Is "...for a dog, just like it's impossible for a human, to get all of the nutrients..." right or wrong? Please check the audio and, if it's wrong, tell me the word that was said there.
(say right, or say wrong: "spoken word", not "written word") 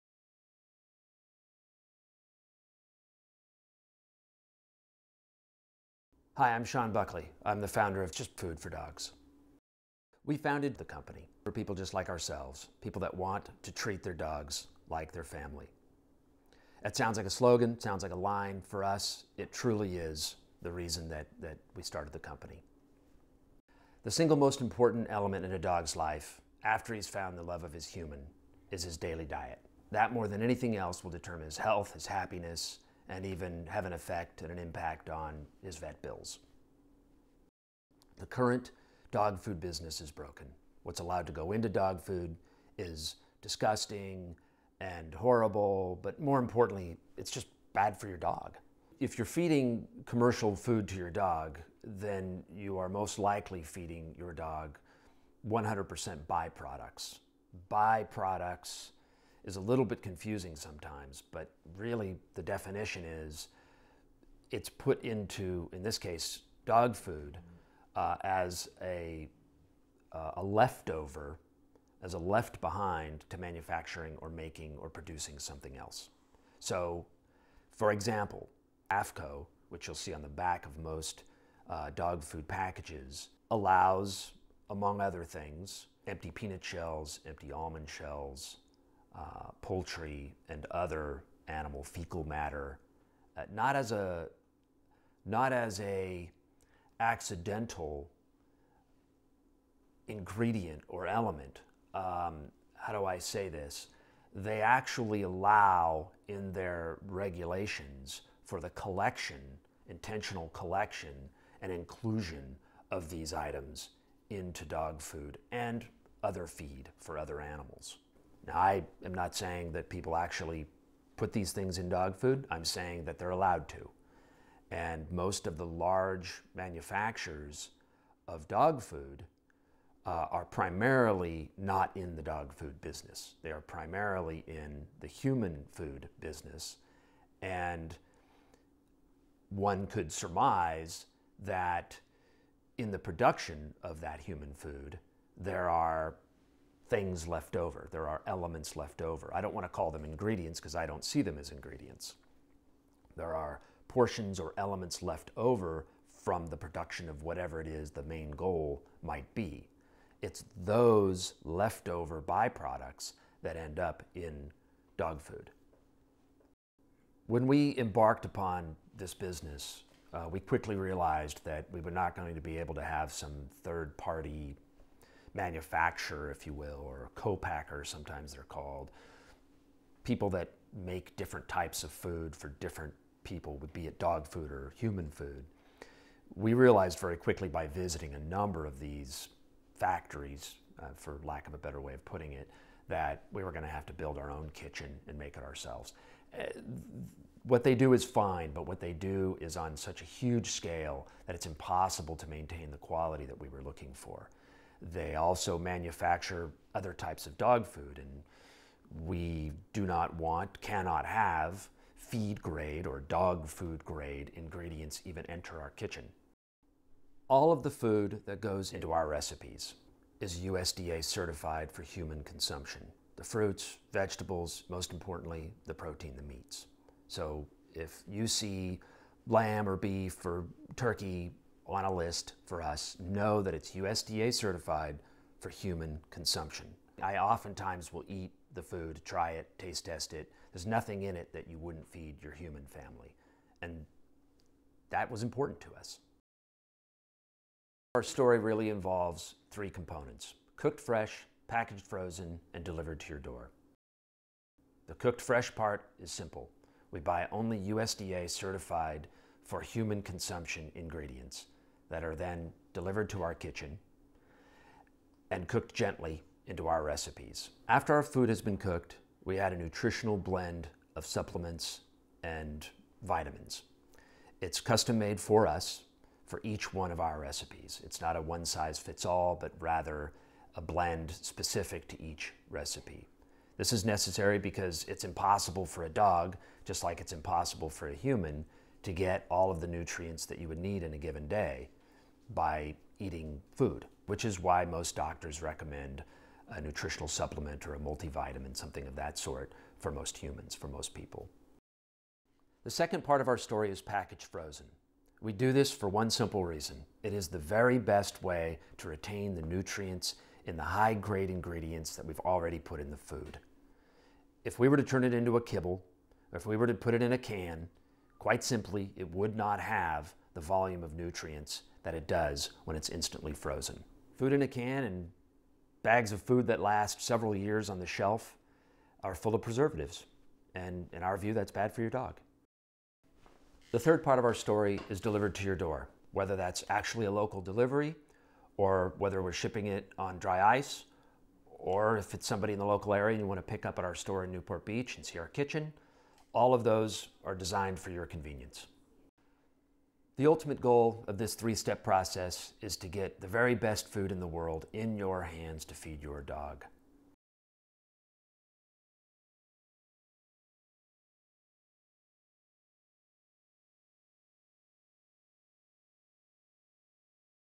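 right.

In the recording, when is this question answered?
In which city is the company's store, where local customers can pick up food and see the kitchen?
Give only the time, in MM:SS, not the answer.
05:44.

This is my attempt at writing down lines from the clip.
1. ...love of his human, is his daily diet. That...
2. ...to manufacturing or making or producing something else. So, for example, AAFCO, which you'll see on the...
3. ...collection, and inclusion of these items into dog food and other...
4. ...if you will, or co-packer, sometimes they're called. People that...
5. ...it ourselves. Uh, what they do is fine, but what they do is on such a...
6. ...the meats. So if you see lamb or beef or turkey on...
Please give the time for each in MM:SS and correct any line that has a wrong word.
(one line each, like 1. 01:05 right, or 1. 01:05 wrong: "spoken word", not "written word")
1. 00:27 right
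2. 01:13 right
3. 01:50 right
4. 02:56 right
5. 03:15 right
6. 03:46 right.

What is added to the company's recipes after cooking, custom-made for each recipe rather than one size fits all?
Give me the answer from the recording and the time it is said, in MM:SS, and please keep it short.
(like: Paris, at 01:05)
nutritional blend, at 04:29.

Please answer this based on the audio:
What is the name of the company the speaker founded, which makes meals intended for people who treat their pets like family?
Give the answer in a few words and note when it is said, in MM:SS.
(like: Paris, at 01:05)
Just Food for Dogs, at 00:08.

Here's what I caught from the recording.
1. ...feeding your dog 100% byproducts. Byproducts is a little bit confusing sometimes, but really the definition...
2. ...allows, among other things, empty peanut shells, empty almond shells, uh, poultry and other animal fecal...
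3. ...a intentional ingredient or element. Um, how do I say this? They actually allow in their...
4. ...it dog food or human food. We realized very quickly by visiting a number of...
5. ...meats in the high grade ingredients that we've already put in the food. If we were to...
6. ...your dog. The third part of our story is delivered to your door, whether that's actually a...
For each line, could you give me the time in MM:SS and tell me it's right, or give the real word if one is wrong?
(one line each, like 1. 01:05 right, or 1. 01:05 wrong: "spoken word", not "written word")
1. 00:53 right
2. 01:23 right
3. 01:35 wrong: "accidental", not "intentional"
4. 03:03 right
5. 05:09 wrong: "nutrients", not "meats"
6. 05:31 right.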